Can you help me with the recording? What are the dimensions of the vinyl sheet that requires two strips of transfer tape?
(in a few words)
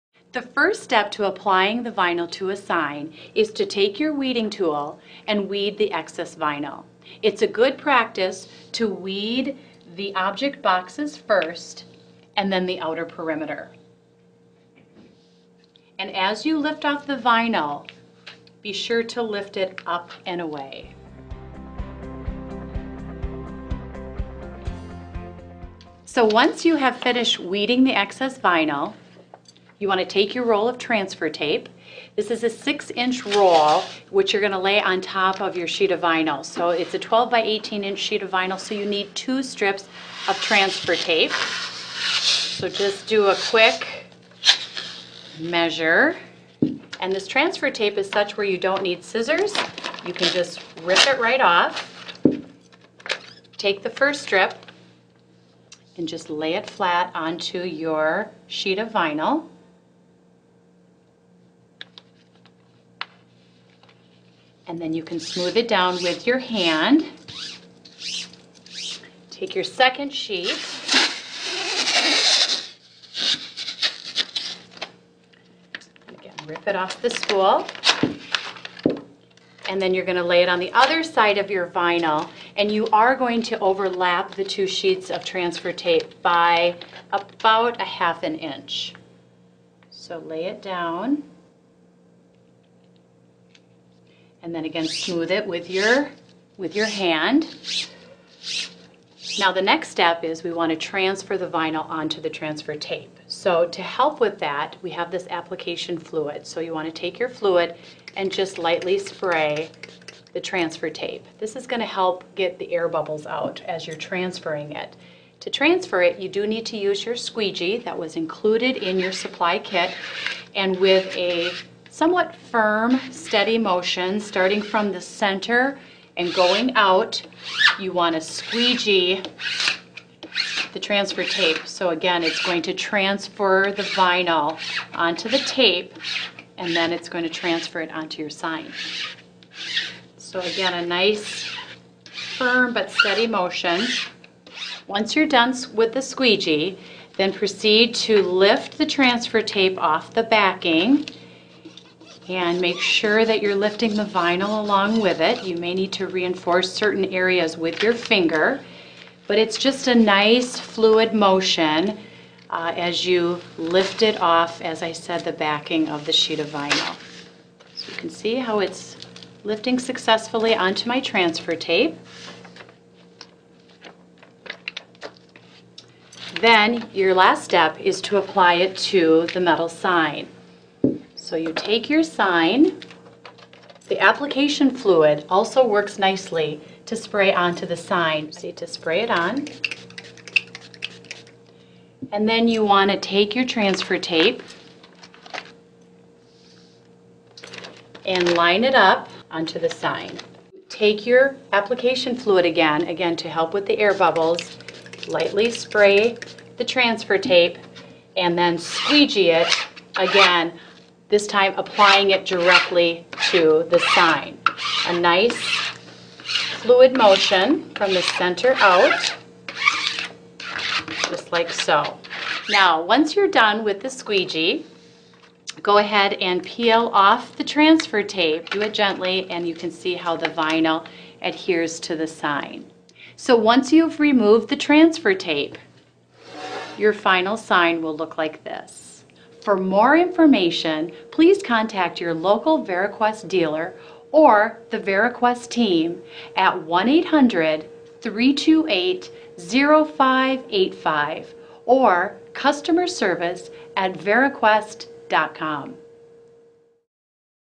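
12 by 18 inch.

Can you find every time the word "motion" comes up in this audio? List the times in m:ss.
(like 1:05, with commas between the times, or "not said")
2:03, 2:23, 2:41, 3:36.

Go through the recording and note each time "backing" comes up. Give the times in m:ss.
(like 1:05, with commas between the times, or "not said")
2:30, 2:45.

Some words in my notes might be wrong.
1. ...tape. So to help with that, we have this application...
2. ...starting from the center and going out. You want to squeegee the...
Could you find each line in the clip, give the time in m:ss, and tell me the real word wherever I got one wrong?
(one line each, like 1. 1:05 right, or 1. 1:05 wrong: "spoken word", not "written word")
1. 1:42 right
2. 2:04 right.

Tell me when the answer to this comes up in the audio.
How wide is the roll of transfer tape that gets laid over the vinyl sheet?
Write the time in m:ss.
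0:32.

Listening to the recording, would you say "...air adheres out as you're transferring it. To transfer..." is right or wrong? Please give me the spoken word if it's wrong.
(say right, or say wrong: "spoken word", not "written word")
wrong: "bubbles", not "adheres".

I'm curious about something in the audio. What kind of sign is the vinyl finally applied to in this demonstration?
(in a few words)
metal sign.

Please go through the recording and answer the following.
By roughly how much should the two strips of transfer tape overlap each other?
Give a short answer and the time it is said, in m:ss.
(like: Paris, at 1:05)
half an inch, at 1:27.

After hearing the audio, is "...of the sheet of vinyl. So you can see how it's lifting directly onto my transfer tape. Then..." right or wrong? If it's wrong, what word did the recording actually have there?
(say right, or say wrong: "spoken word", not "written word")
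wrong: "successfully", not "directly".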